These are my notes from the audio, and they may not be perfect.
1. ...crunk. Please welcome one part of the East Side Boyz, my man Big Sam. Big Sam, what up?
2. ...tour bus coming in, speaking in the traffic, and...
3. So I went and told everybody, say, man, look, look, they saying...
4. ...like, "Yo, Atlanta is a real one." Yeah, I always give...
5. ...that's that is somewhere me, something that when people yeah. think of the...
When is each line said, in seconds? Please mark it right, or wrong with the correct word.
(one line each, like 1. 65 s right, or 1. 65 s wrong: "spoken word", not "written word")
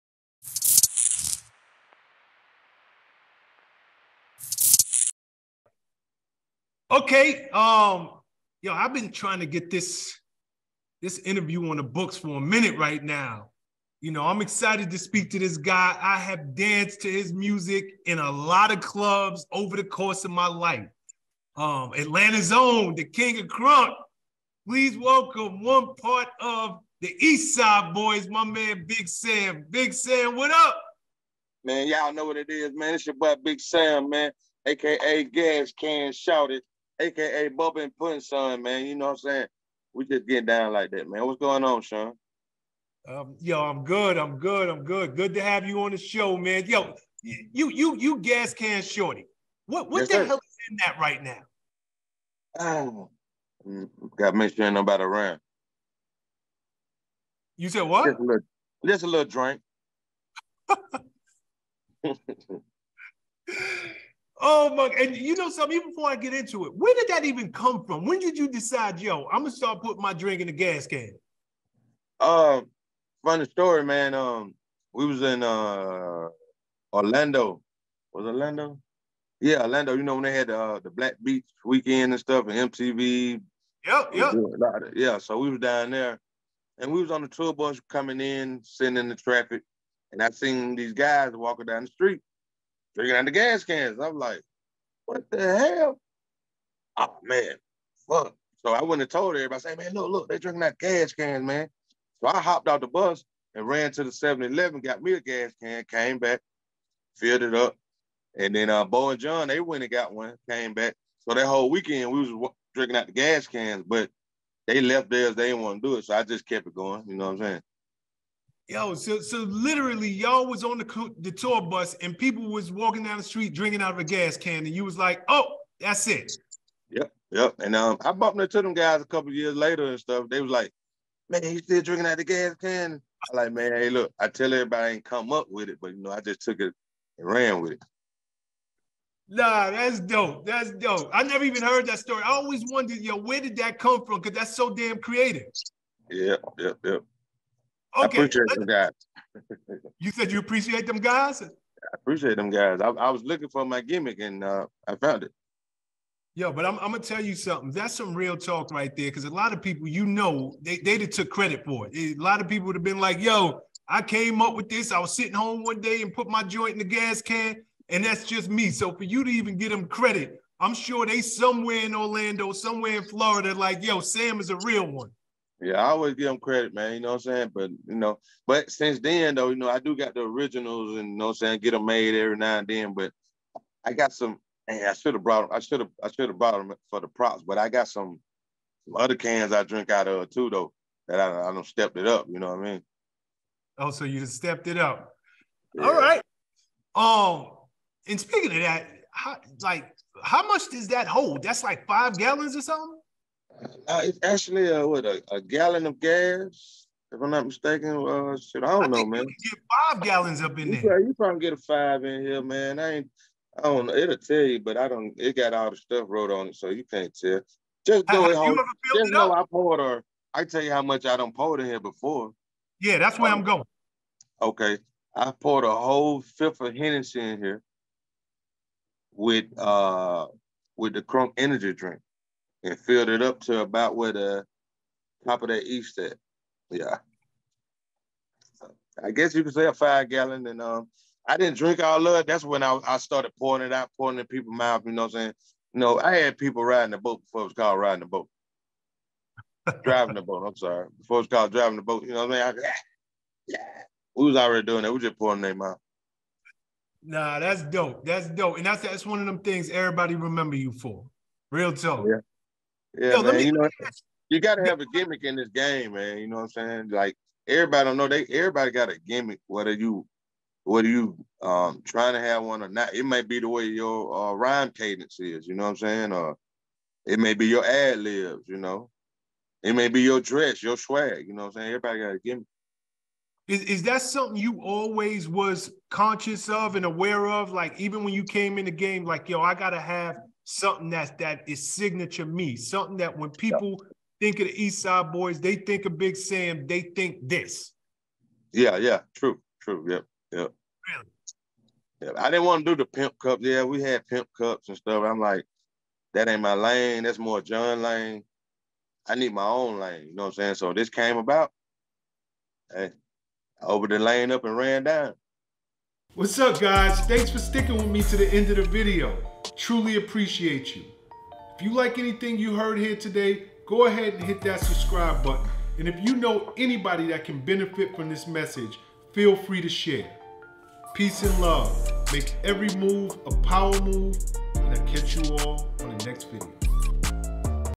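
1. 23 s right
2. 87 s wrong: "sitting", not "speaking"
3. 98 s wrong: "drinking", not "saying"
4. 173 s wrong: "Sam", not "Atlanta"
5. 290 s wrong: "signature", not "somewhere".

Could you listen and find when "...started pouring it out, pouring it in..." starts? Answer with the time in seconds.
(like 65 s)
242 s.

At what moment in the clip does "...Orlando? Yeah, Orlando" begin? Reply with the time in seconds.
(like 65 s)
78 s.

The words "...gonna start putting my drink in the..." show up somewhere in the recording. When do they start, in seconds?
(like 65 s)
69 s.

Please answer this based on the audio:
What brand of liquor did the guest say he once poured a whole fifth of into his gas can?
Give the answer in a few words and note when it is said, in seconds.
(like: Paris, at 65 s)
Hennessy, at 226 s.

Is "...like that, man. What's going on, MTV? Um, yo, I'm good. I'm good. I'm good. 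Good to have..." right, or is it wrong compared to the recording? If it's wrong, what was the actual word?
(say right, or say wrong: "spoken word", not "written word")
wrong: "Shawn", not "MTV".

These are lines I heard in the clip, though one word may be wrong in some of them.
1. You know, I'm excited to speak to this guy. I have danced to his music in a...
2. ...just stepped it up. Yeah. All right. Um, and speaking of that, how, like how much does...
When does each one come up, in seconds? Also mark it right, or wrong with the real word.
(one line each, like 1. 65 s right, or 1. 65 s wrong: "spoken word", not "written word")
1. 14 s right
2. 194 s right.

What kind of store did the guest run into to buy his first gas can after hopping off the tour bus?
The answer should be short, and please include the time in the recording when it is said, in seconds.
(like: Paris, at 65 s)
7-Eleven, at 104 s.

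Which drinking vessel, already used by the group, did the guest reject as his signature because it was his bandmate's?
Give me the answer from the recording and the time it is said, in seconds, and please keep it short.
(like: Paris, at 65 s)
pimp cup, at 302 s.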